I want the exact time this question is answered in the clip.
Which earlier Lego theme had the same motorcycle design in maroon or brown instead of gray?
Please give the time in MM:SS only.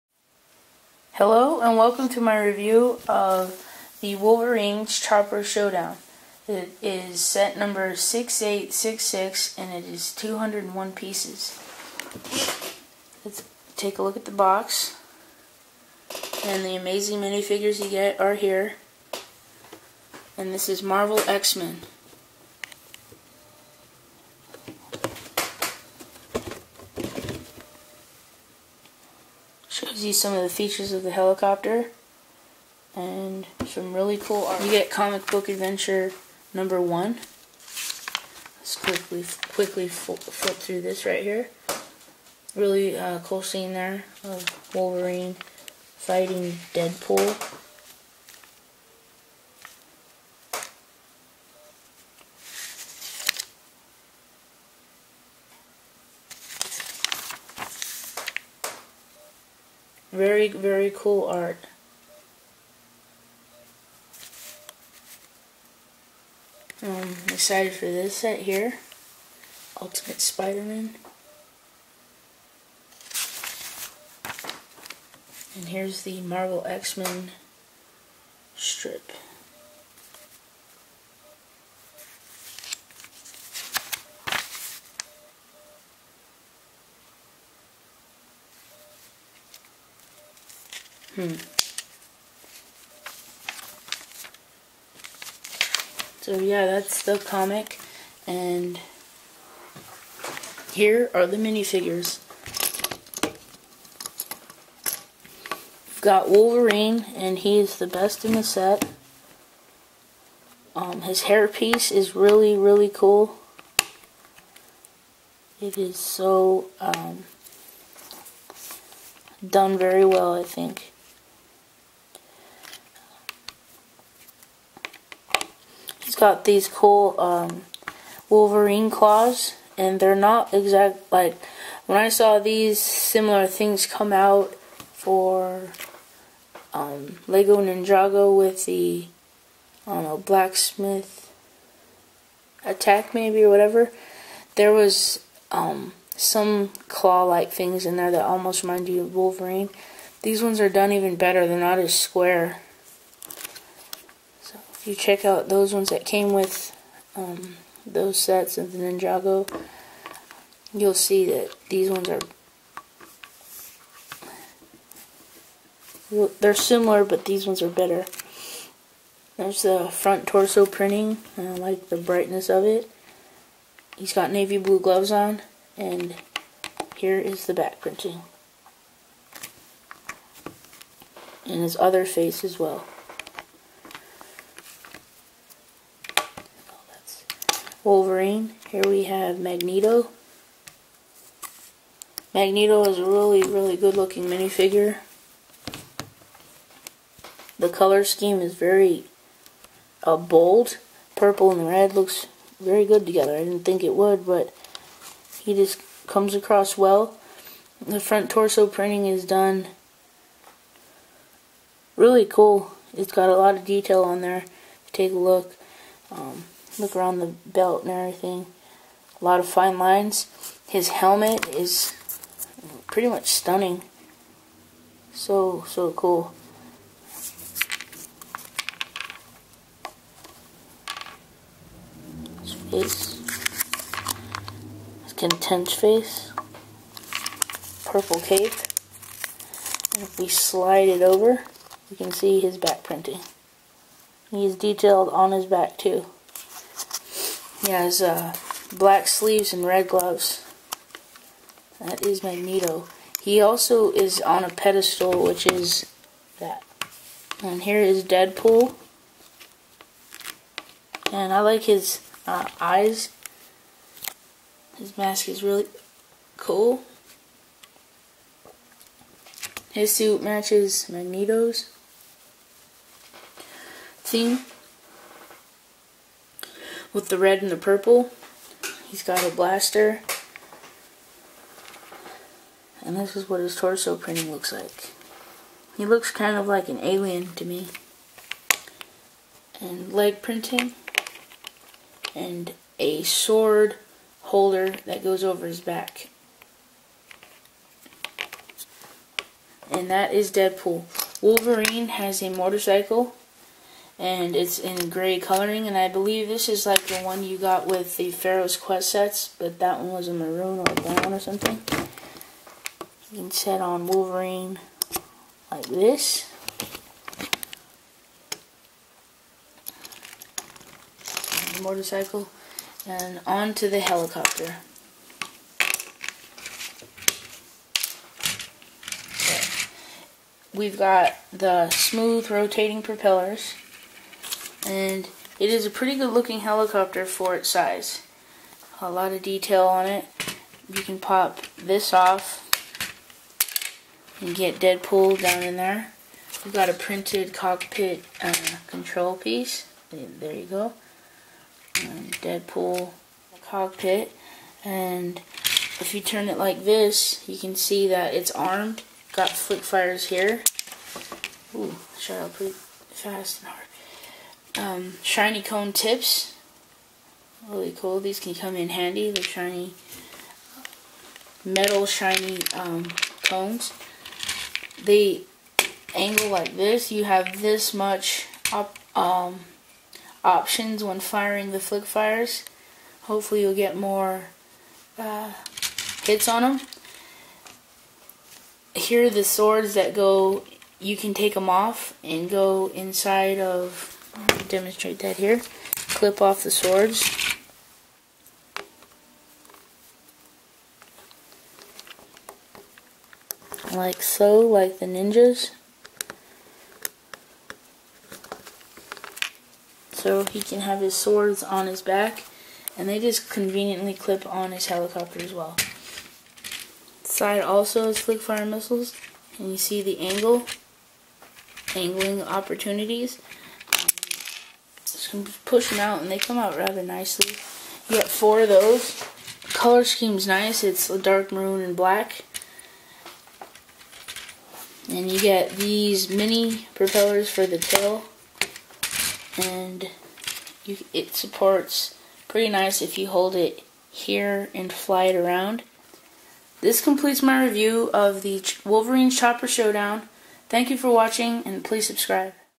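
05:08.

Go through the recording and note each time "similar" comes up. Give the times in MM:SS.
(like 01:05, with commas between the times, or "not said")
02:12, 02:46.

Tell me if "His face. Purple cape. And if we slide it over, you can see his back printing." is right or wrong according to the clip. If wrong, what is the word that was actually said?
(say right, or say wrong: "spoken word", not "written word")
right.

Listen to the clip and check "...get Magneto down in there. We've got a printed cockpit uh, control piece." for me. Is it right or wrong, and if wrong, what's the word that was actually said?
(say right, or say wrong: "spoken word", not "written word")
wrong: "Deadpool", not "Magneto".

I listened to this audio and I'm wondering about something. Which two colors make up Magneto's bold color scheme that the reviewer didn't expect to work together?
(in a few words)
Purple and red.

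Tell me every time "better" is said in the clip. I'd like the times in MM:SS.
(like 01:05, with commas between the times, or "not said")
02:31, 02:47.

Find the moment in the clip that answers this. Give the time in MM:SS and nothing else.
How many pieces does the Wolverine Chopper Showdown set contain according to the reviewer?
00:10.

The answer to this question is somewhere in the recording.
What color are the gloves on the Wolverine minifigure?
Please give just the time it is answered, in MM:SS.
02:54.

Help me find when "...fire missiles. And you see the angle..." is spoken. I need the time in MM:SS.
06:58.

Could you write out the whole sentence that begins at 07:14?
And you get these mini propellers for the tail.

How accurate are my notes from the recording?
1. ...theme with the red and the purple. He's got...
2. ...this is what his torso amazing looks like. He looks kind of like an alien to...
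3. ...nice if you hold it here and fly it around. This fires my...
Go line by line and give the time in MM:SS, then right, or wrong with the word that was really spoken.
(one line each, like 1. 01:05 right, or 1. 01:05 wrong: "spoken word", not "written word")
1. 04:34 right
2. 04:42 wrong: "printing", not "amazing"
3. 07:22 wrong: "completes", not "fires".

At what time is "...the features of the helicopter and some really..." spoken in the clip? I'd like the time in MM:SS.
00:30.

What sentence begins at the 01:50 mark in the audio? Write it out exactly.
Um, his hairpiece is really, really cool.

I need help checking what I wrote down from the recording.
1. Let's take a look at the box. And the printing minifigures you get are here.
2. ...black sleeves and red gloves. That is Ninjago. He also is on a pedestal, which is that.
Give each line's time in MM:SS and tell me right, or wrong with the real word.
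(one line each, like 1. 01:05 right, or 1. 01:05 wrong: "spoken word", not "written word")
1. 00:13 wrong: "amazing", not "printing"
2. 04:08 wrong: "Magneto", not "Ninjago".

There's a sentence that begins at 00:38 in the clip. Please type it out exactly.
Let's quickly quickly flip through this right here.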